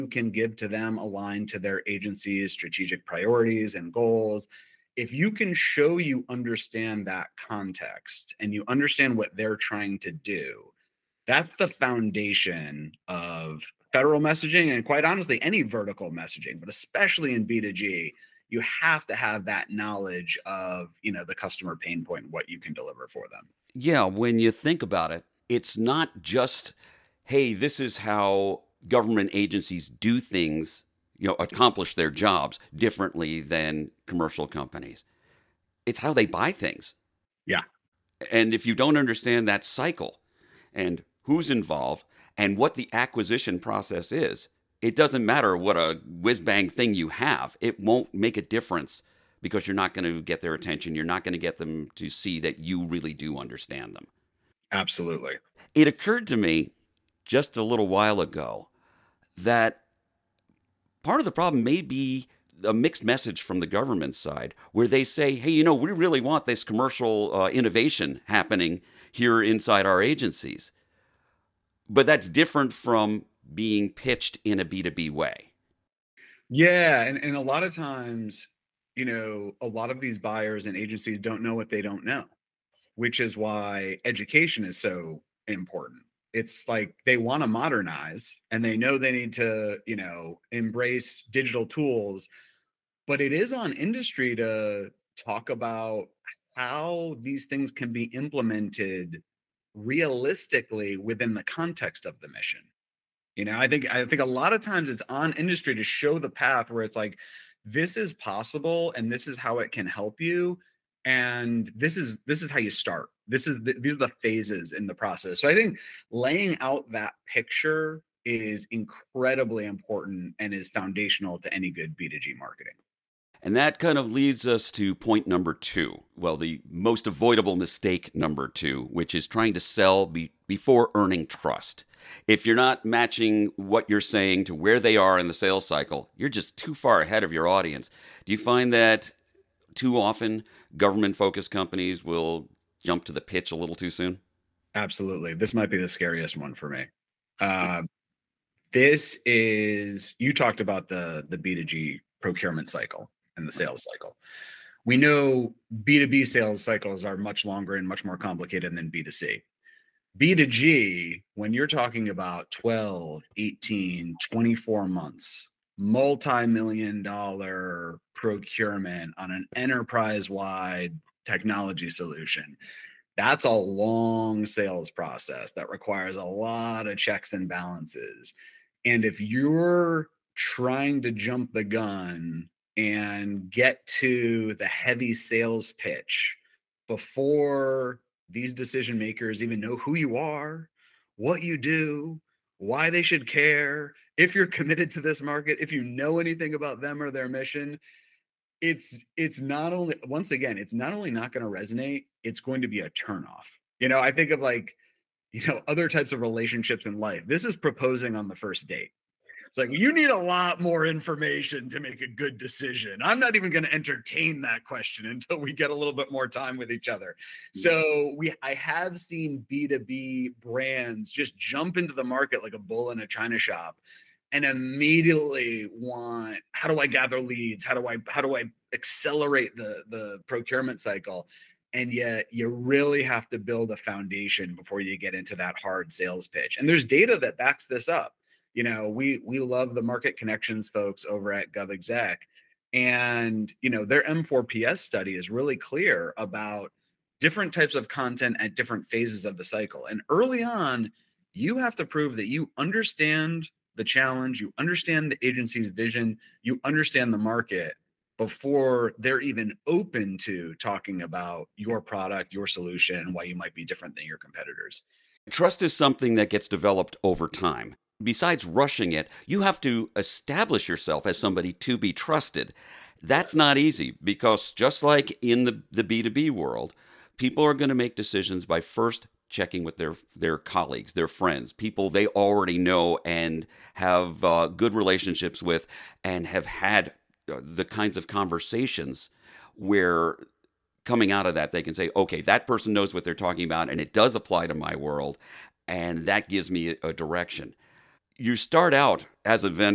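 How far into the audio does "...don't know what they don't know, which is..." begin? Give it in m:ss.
1:21.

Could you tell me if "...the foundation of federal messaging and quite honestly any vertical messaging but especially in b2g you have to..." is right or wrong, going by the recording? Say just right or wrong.
right.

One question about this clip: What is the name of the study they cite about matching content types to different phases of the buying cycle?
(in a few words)
M4PS.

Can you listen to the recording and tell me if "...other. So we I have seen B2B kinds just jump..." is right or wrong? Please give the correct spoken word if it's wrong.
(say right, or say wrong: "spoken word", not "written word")
wrong: "brands", not "kinds".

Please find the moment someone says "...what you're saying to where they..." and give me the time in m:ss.
2:13.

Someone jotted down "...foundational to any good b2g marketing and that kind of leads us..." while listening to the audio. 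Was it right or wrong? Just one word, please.
right.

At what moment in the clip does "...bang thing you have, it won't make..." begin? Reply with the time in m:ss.
0:46.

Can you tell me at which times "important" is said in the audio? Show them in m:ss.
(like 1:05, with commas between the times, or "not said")
1:25, 1:59.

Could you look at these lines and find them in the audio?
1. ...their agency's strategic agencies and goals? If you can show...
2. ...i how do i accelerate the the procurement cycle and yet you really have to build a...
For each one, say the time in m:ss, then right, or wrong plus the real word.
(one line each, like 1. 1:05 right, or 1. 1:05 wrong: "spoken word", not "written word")
1. 0:01 wrong: "priorities", not "agencies"
2. 3:47 right.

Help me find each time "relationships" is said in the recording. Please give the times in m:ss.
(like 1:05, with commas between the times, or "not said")
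3:26, 4:44.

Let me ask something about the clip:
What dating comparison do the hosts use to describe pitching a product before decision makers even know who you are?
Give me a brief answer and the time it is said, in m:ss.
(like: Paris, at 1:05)
Proposing on the first date, at 3:27.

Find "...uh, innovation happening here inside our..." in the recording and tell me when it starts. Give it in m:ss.
1:07.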